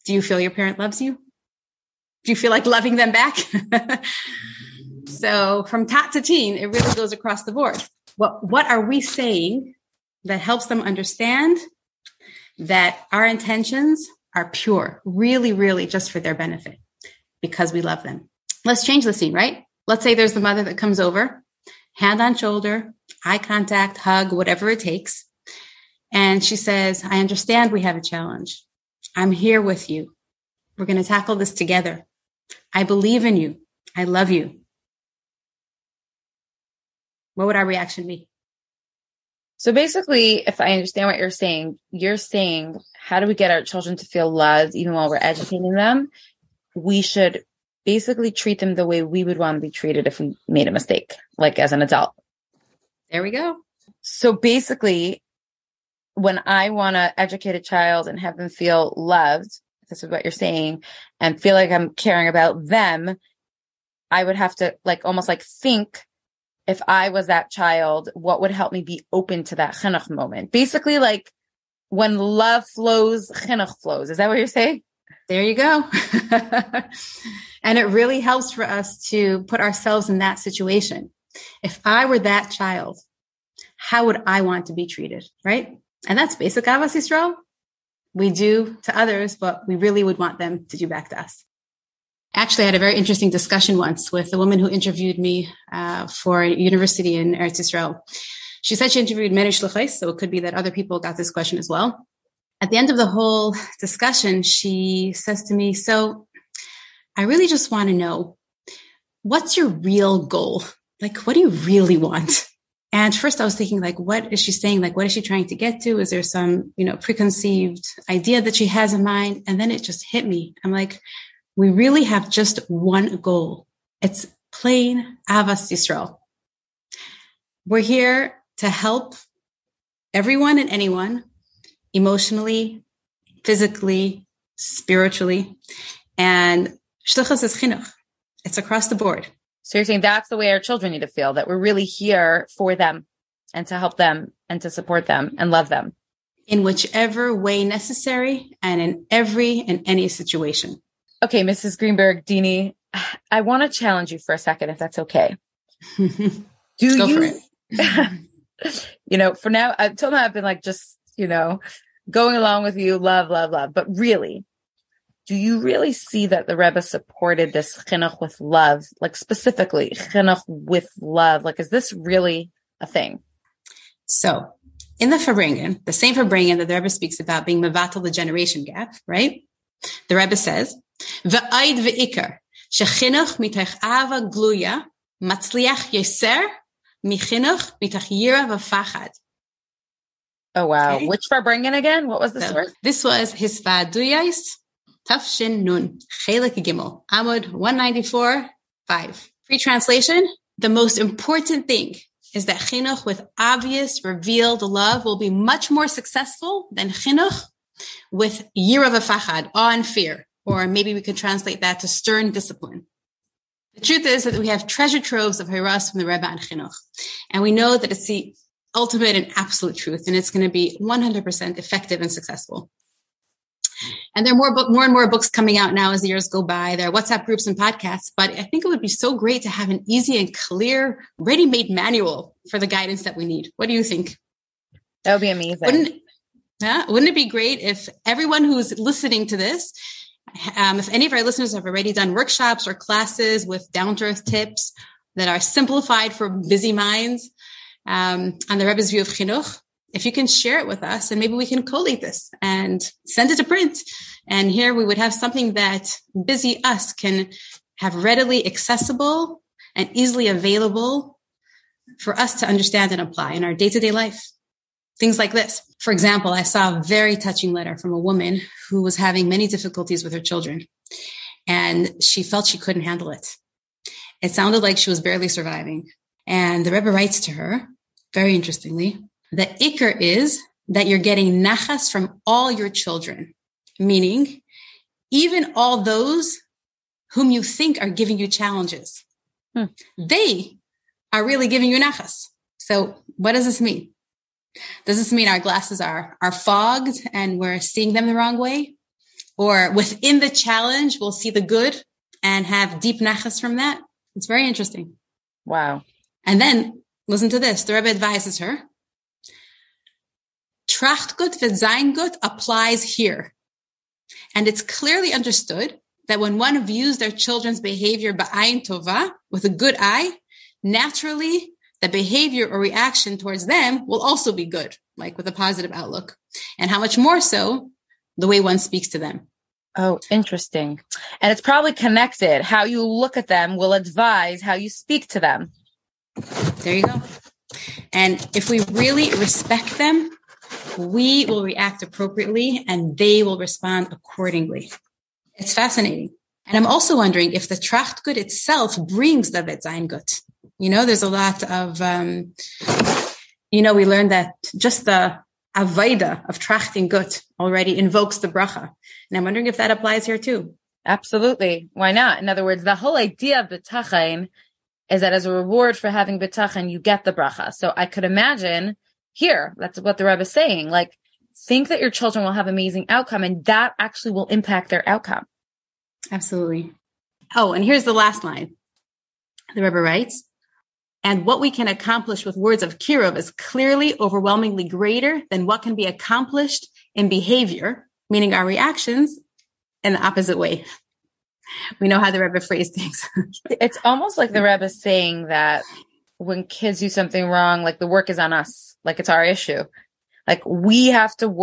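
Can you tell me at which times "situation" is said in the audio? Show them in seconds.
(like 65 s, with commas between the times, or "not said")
80 s, 150 s.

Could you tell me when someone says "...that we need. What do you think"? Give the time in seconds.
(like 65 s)
233 s.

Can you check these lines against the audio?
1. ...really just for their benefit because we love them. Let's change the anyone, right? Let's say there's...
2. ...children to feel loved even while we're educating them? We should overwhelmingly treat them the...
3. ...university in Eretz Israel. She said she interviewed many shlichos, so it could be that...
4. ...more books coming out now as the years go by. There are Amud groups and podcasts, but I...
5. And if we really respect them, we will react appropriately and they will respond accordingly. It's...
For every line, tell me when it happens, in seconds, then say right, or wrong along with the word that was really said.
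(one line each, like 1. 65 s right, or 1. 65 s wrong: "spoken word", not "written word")
1. 15 s wrong: "scene", not "anyone"
2. 43 s wrong: "basically", not "overwhelmingly"
3. 96 s right
4. 224 s wrong: "WhatsApp", not "Amud"
5. 337 s right.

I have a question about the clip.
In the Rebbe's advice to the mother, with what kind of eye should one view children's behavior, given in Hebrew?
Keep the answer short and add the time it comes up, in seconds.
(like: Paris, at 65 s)
Ba'ayin tova, at 318 s.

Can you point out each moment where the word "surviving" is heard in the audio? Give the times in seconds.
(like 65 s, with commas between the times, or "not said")
275 s.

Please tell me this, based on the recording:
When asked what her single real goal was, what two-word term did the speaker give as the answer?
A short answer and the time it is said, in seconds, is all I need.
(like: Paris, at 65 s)
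Avas Yisrael, at 125 s.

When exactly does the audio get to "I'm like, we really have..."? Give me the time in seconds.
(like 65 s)
120 s.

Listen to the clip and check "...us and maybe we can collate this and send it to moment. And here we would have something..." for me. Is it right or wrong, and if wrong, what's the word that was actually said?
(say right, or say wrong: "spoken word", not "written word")
wrong: "print", not "moment".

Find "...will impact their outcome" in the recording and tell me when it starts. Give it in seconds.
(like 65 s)
374 s.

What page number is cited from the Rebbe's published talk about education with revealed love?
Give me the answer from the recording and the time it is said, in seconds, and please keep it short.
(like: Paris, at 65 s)
194, at 197 s.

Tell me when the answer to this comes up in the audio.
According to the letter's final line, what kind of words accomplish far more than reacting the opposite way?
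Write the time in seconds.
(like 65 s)
382 s.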